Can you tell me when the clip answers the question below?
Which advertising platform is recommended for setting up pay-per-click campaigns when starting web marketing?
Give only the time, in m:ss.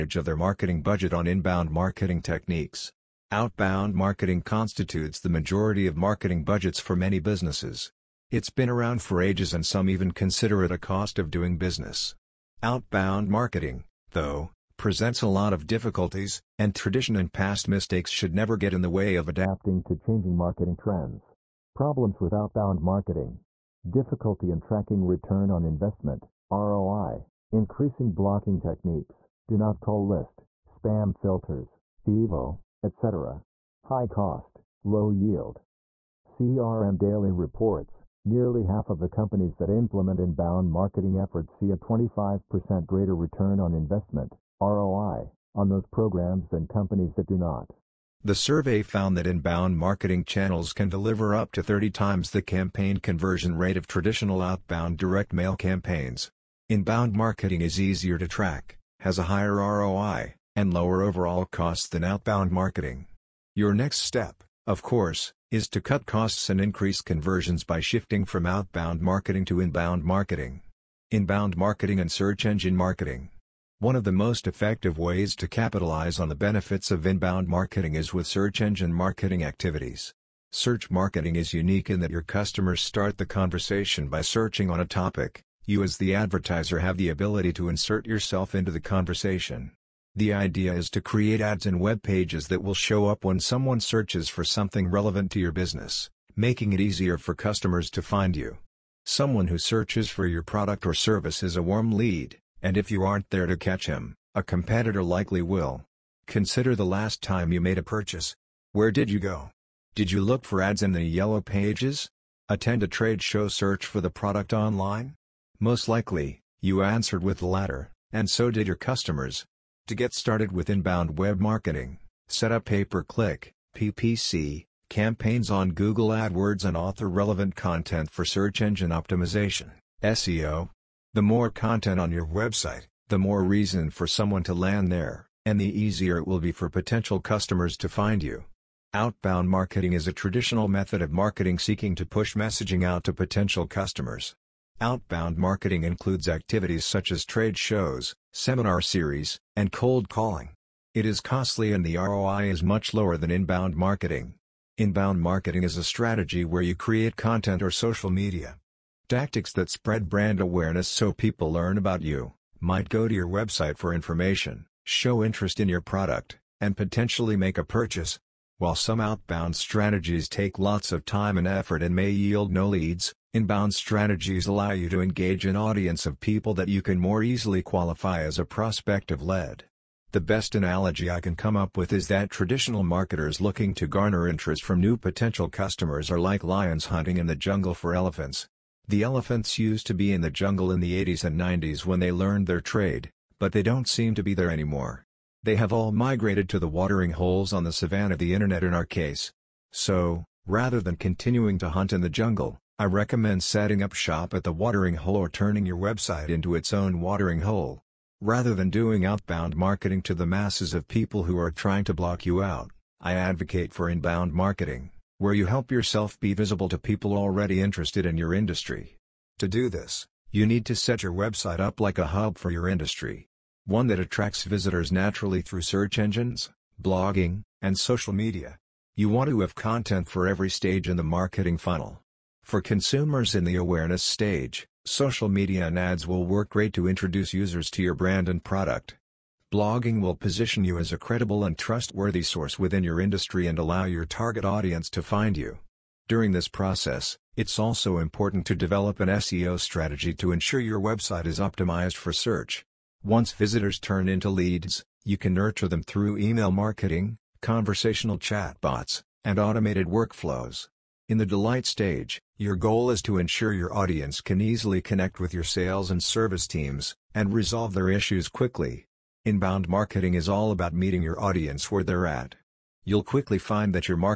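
2:05.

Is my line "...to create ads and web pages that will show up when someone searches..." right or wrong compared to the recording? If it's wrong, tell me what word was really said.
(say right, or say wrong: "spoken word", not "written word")
right.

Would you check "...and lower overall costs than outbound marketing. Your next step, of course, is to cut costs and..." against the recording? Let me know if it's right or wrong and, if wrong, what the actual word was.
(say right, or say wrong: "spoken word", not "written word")
right.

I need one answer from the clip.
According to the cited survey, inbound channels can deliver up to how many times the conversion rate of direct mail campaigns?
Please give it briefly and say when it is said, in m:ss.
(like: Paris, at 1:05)
30 times, at 0:51.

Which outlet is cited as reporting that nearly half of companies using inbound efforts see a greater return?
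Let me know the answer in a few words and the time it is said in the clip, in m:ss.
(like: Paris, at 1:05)
CRM Daily, at 0:36.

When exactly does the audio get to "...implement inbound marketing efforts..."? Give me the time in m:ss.
0:39.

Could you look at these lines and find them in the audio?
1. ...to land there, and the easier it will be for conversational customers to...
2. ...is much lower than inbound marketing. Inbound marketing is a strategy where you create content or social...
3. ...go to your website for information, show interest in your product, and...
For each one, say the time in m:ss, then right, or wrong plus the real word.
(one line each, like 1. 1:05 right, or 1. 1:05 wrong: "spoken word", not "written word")
1. 2:14 wrong: "potential", not "conversational"
2. 2:32 right
3. 2:42 right.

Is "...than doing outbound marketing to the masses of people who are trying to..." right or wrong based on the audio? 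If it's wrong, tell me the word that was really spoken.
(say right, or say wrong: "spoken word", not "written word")
right.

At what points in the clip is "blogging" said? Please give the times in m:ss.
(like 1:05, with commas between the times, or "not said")
3:46, 3:59.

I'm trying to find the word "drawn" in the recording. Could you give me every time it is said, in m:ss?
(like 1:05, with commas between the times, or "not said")
not said.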